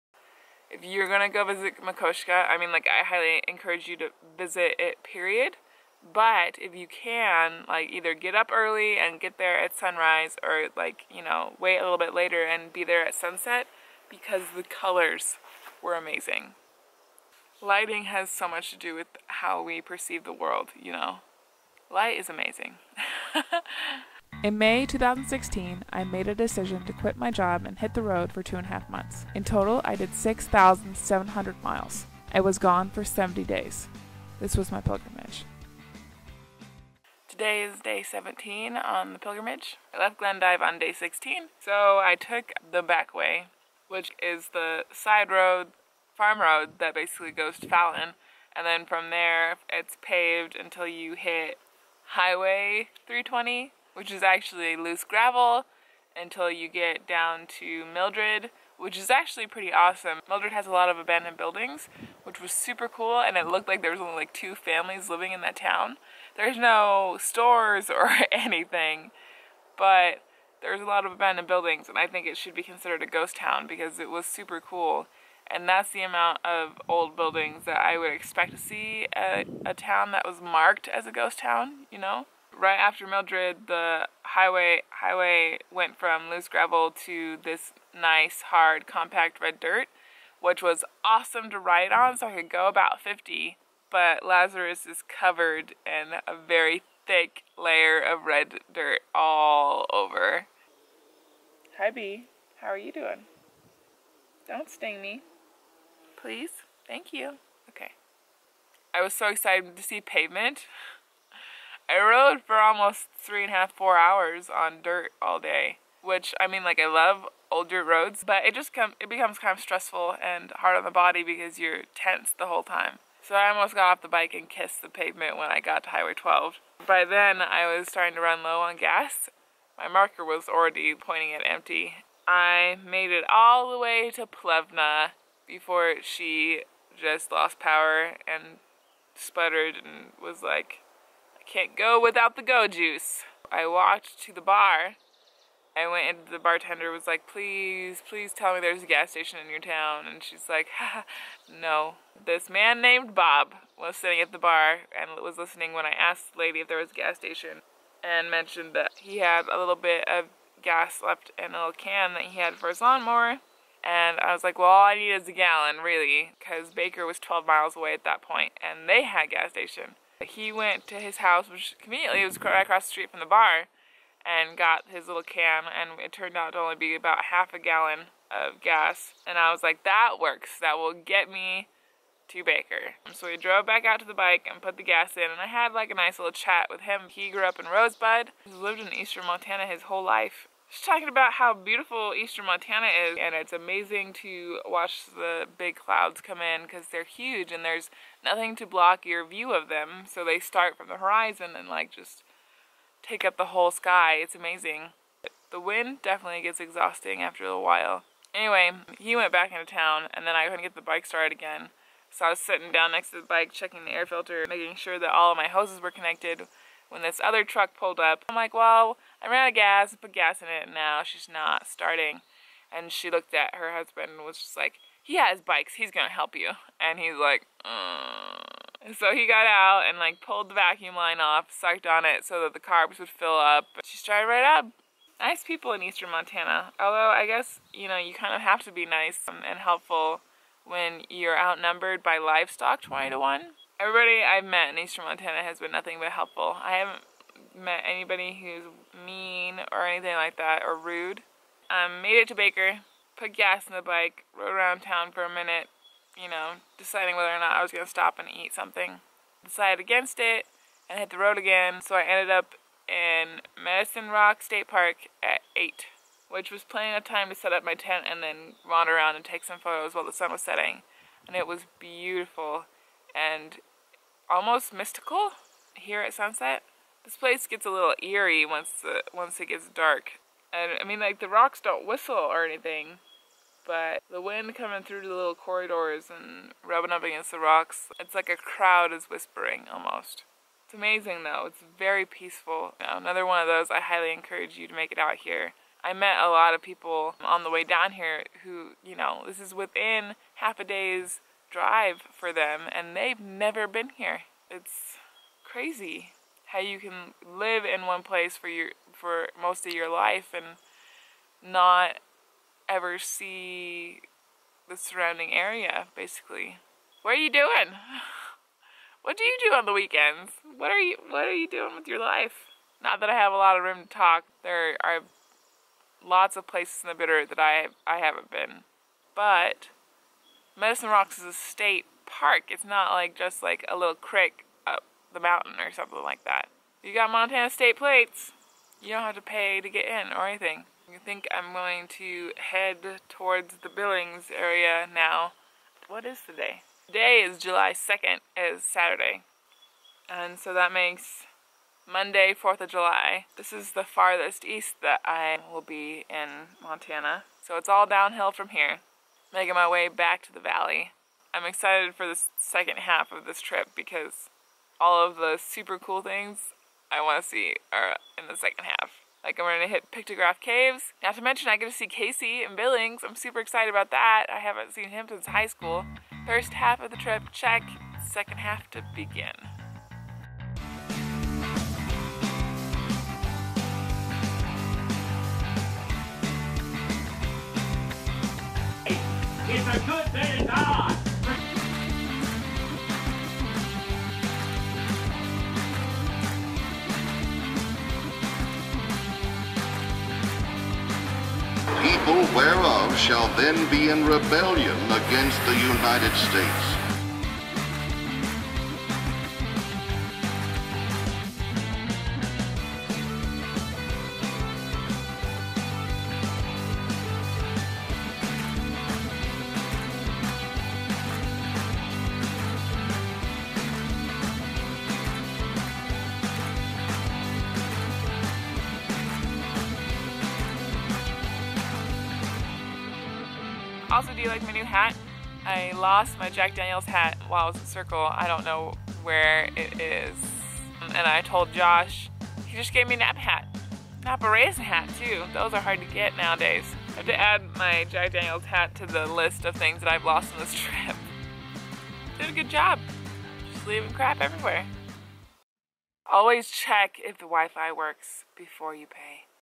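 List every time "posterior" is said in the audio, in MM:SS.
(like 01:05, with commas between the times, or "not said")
not said.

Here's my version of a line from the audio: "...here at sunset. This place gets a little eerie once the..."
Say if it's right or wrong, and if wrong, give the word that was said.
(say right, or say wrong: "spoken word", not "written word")
right.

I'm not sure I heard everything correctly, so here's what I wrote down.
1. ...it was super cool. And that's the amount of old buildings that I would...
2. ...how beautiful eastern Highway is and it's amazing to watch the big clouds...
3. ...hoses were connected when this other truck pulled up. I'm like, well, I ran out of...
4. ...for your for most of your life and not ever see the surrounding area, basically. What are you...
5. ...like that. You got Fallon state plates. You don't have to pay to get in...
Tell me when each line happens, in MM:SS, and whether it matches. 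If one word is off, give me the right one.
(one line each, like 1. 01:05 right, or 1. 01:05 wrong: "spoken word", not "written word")
1. 01:13 right
2. 03:11 wrong: "Montana", not "Highway"
3. 03:35 right
4. 05:08 right
5. 05:36 wrong: "Montana", not "Fallon".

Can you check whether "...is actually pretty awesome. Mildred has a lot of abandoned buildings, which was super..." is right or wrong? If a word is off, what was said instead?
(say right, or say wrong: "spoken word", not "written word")
right.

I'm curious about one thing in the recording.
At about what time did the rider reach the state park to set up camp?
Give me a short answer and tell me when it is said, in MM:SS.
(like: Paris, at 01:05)
8, at 04:25.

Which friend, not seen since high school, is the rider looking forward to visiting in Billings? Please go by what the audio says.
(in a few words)
Casey.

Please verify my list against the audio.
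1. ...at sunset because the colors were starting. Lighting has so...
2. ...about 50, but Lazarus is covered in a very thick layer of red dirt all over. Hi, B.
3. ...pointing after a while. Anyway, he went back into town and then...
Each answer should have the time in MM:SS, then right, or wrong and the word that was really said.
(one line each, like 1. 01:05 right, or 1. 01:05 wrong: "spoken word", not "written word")
1. 00:13 wrong: "amazing", not "starting"
2. 01:32 right
3. 03:26 wrong: "exhausting", not "pointing".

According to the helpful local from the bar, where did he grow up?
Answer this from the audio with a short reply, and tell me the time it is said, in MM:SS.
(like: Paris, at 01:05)
Rosebud, at 03:07.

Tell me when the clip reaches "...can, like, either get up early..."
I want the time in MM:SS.
00:06.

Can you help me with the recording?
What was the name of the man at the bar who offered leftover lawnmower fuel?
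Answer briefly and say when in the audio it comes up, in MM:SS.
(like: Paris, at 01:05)
Bob, at 02:33.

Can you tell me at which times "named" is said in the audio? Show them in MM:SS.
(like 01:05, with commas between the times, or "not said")
02:32.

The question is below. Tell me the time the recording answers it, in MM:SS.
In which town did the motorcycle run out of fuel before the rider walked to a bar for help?
02:14.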